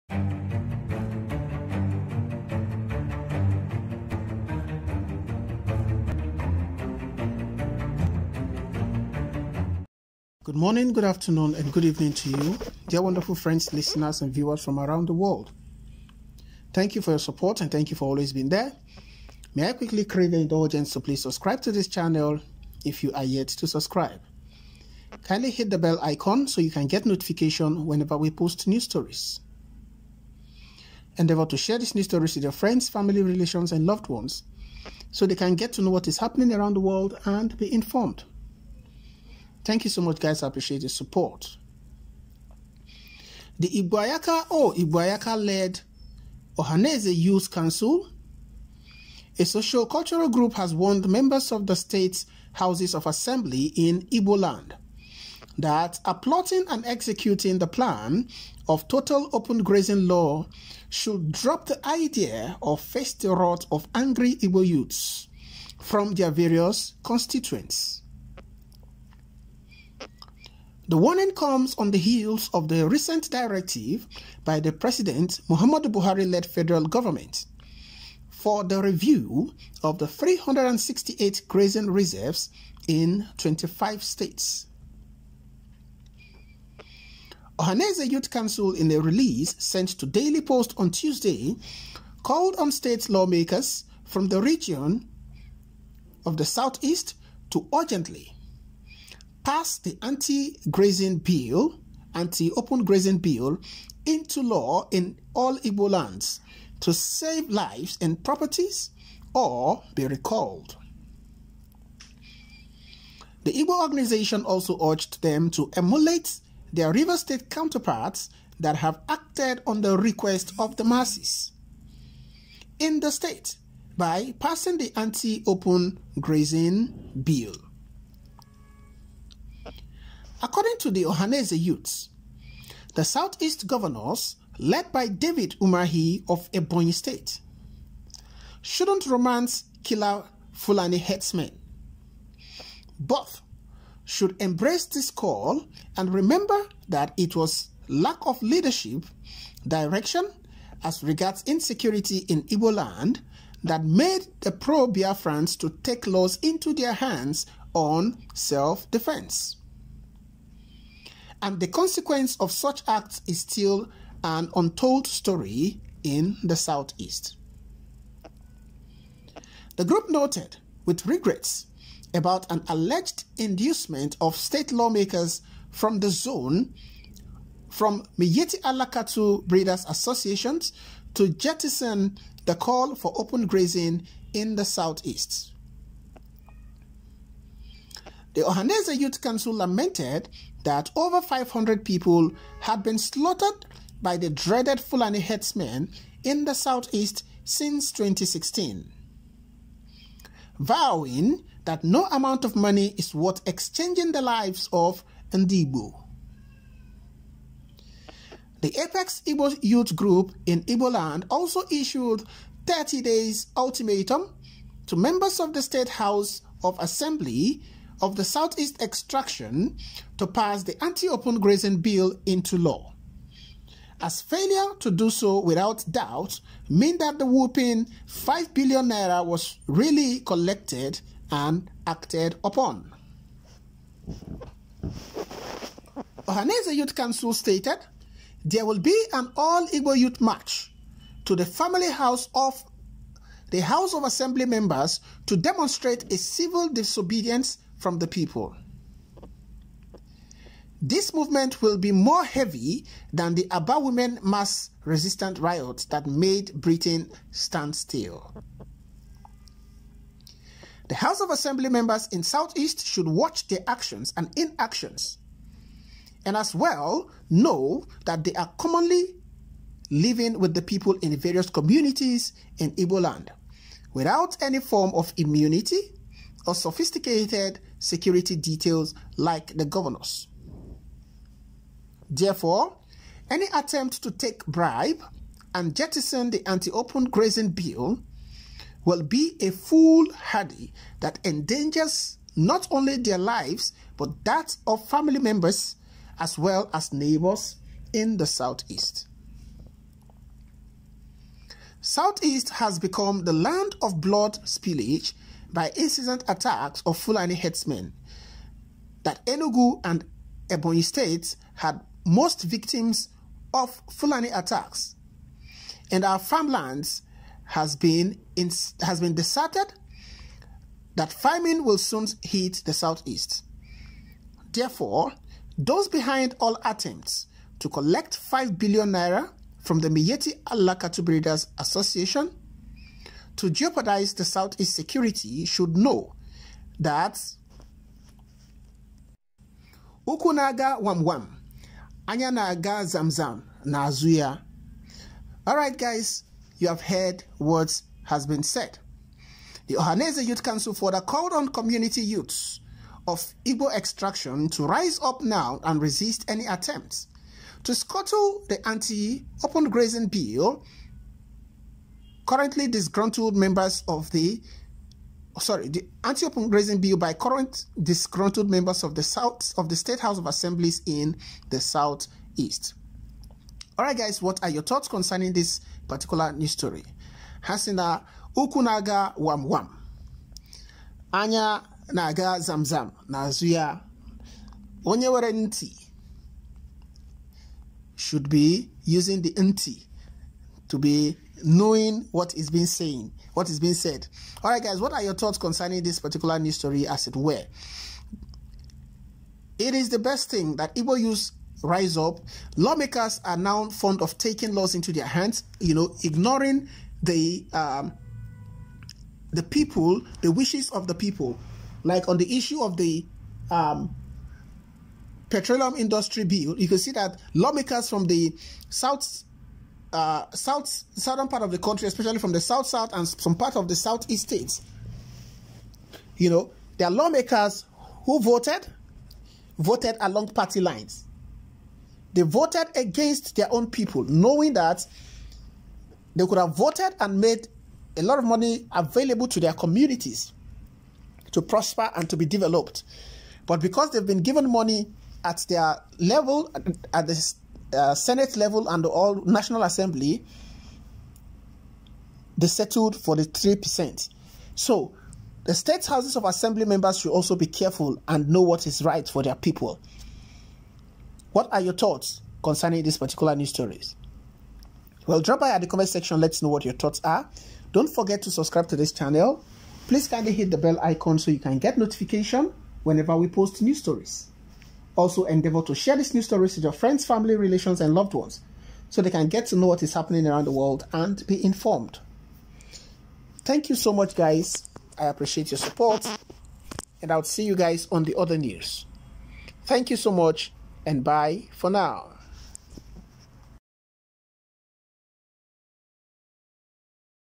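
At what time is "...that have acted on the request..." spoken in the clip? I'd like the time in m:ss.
1:58.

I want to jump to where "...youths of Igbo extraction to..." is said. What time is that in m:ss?
5:52.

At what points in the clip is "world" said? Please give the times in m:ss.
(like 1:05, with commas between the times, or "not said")
0:15, 0:36, 8:00.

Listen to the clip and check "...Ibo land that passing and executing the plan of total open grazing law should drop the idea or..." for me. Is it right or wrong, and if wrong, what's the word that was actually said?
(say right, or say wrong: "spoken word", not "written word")
wrong: "plotting", not "passing".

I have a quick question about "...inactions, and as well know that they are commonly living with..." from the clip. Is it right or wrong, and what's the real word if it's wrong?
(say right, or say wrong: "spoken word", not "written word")
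right.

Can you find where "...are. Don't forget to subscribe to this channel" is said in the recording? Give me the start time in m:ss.
7:47.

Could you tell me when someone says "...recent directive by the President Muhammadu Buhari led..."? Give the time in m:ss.
1:12.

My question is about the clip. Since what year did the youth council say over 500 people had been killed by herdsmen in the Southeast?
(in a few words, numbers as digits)
2016.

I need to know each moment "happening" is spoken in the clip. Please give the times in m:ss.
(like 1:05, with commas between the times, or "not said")
0:36, 7:59.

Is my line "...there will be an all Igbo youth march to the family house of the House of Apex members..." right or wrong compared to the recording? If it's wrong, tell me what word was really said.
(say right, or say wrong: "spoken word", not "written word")
wrong: "Assembly", not "Apex".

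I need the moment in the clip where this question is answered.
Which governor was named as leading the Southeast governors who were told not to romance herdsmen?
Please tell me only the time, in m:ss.
2:15.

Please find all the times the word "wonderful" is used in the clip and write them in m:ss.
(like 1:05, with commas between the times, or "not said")
0:13.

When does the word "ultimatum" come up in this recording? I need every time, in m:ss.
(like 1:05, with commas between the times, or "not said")
3:33.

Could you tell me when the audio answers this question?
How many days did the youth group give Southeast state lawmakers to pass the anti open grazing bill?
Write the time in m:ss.
3:32.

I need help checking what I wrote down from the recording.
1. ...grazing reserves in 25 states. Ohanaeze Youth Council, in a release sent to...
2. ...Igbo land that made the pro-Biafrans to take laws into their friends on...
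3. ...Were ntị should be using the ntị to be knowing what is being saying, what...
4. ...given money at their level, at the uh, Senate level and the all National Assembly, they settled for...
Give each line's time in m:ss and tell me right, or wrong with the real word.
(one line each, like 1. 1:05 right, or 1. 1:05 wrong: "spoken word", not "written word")
1. 1:21 right
2. 2:32 wrong: "hands", not "friends"
3. 6:25 right
4. 7:24 right.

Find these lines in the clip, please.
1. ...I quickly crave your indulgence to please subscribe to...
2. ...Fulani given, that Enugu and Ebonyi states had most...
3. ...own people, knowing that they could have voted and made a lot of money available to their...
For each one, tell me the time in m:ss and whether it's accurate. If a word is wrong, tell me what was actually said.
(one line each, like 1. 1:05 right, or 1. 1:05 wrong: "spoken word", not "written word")
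1. 0:19 right
2. 5:06 wrong: "herdsmen", not "given"
3. 7:13 right.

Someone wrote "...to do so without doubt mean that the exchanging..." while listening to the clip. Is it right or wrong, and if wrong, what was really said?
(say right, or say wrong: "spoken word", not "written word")
wrong: "whooping", not "exchanging".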